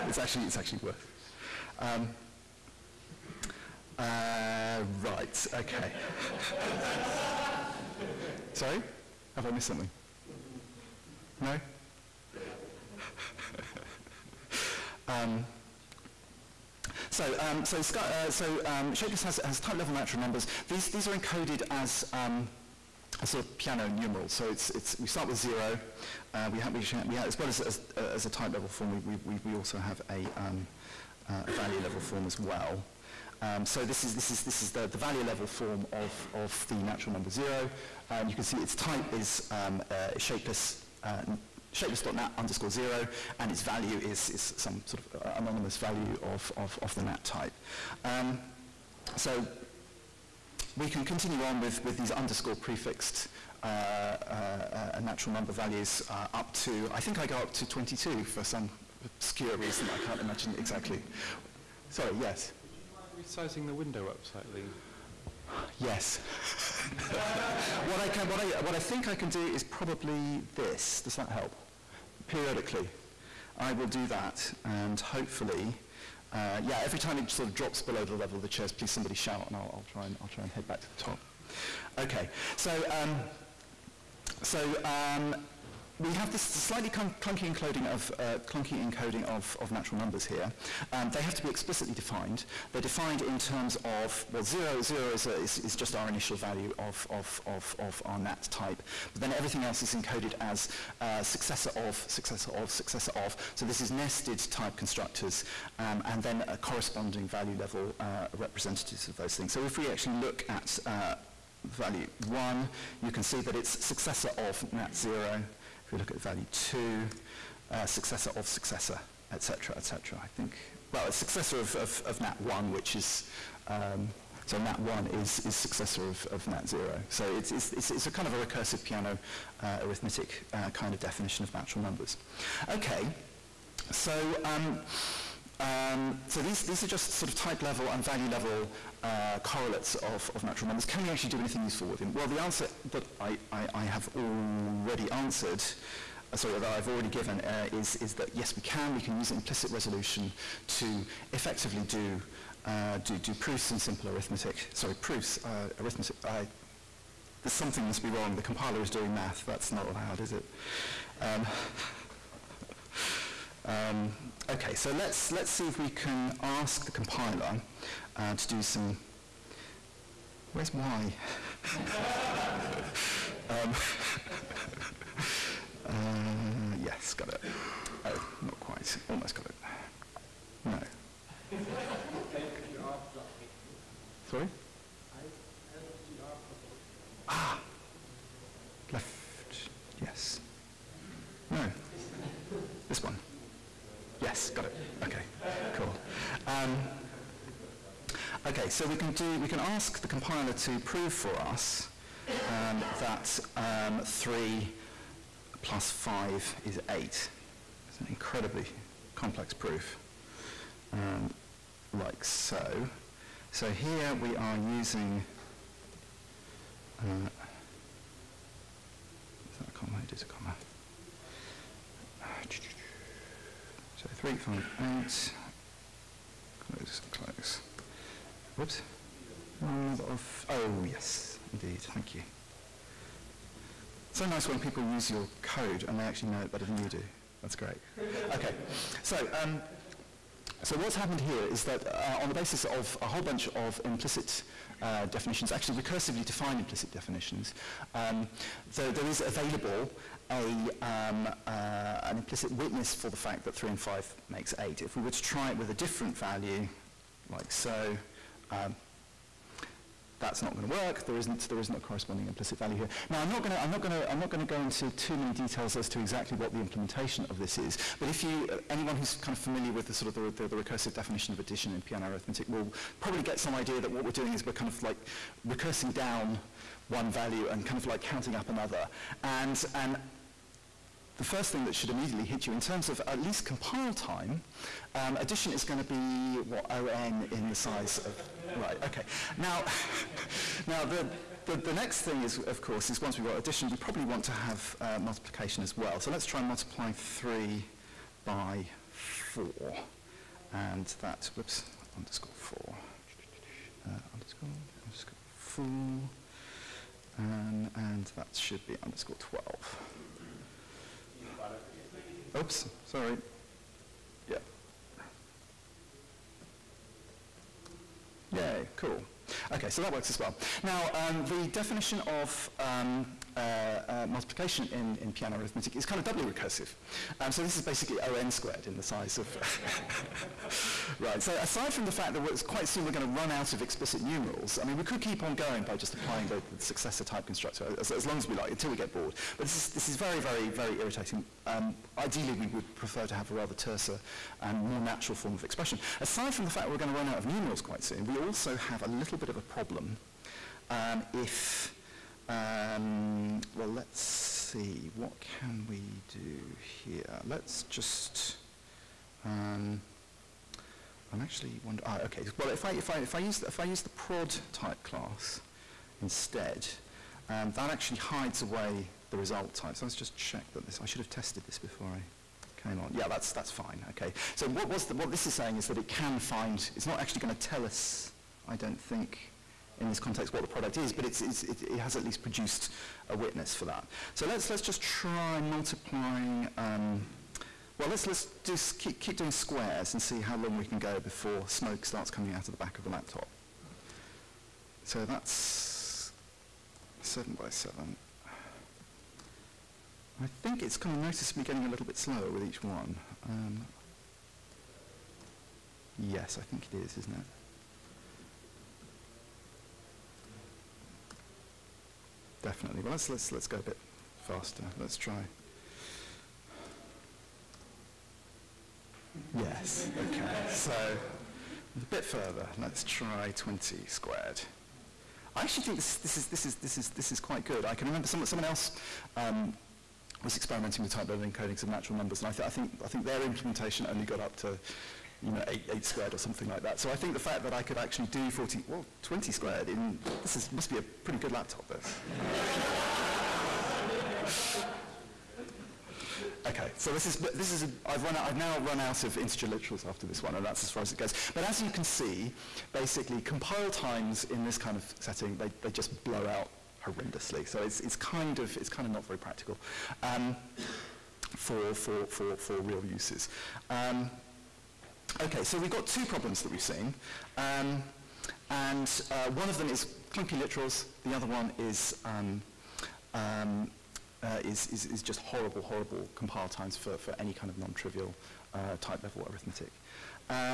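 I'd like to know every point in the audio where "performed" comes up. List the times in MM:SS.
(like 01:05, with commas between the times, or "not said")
not said.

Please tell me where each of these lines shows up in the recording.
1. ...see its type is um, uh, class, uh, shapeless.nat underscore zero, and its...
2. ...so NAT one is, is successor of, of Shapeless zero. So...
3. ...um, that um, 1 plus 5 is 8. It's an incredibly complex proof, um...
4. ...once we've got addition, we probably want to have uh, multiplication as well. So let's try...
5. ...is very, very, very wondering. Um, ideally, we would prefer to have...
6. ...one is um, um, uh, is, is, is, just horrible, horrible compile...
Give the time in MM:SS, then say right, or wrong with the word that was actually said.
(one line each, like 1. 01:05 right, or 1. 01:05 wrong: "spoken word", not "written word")
1. 00:38 wrong: "shapeless", not "class"
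2. 02:04 wrong: "NAT", not "Shapeless"
3. 03:22 wrong: "3", not "1"
4. 04:53 right
5. 05:39 wrong: "irritating", not "wondering"
6. 07:51 right.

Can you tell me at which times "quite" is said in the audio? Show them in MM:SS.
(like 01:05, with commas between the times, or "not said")
02:58, 05:32, 05:47, 07:07.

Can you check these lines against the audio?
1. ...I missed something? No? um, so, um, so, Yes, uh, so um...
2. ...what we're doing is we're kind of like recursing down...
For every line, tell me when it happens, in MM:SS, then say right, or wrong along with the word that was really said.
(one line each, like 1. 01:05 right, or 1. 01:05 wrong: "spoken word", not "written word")
1. 00:09 wrong: "Sky", not "Yes"
2. 04:33 right.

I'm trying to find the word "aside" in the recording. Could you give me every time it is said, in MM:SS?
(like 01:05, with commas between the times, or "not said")
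05:31, 05:45.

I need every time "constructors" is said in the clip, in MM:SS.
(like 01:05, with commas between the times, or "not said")
01:44, 05:37.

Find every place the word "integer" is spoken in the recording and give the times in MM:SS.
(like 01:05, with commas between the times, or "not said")
07:29.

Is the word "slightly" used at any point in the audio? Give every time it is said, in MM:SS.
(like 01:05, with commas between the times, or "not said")
01:04, 01:26.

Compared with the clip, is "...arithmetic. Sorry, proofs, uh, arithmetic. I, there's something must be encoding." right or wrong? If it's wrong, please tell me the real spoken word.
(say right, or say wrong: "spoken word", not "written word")
wrong: "wrong", not "encoding".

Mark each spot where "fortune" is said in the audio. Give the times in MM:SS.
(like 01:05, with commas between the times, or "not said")
not said.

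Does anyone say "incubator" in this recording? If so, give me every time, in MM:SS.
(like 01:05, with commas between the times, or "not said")
not said.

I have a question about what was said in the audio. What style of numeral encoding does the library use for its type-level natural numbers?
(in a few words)
Peano numeral.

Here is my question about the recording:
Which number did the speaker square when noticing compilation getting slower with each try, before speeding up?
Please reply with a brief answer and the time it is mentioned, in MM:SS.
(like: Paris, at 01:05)
7, at 06:37.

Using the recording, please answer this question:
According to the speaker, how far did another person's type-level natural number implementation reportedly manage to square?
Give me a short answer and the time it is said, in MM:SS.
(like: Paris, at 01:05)
8 squared, at 07:15.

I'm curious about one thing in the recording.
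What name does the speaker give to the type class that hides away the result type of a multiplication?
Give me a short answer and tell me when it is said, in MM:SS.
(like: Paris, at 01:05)
prod, at 06:03.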